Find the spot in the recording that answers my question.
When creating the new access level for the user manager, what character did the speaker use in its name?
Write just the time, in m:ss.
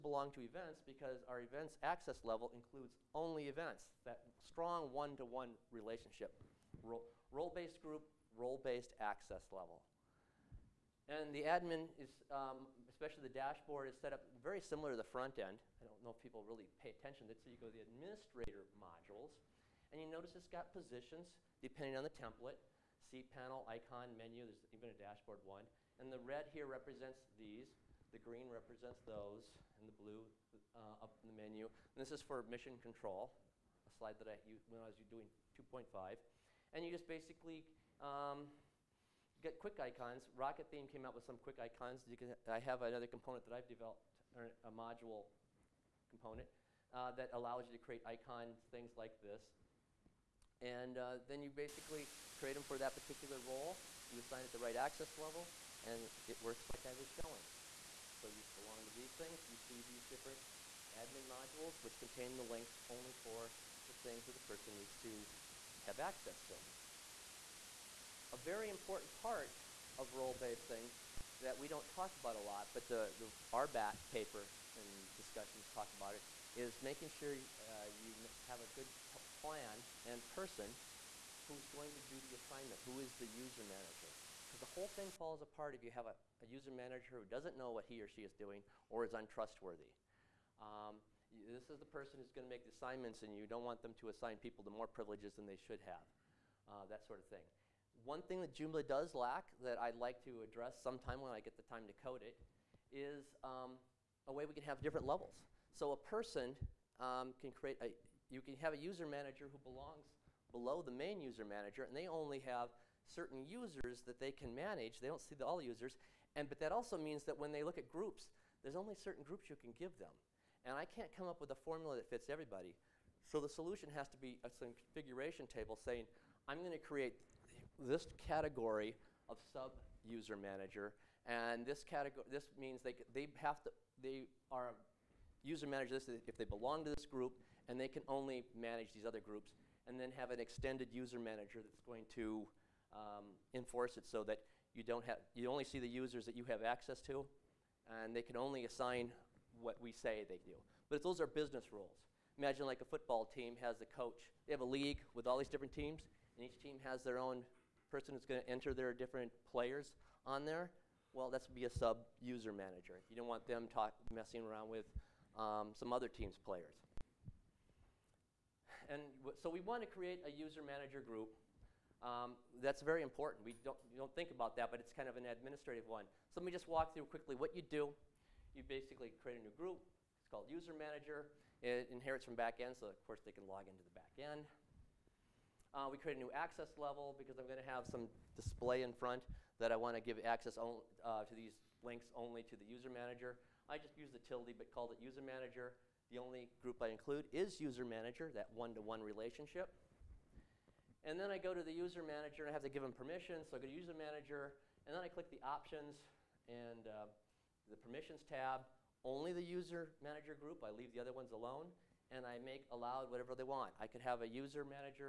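3:14.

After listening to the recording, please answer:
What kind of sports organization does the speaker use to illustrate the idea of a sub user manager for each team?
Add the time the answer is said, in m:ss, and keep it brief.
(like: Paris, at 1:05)
football team, at 2:32.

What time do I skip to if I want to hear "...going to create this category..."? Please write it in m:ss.
2:06.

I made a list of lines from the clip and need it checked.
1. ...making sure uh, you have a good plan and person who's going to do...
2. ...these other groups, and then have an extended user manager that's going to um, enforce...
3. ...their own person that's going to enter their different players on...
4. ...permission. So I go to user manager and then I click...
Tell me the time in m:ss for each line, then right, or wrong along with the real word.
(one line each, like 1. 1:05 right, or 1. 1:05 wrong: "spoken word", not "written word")
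1. 1:16 right
2. 2:18 right
3. 2:37 right
4. 3:22 right.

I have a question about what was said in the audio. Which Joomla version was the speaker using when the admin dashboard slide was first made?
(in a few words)
2.5.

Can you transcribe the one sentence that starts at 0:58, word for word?
So you belong to these things.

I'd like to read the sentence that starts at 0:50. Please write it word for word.
And uh, then you basically create them for that particular role.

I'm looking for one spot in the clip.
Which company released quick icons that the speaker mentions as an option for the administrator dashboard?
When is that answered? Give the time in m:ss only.
0:40.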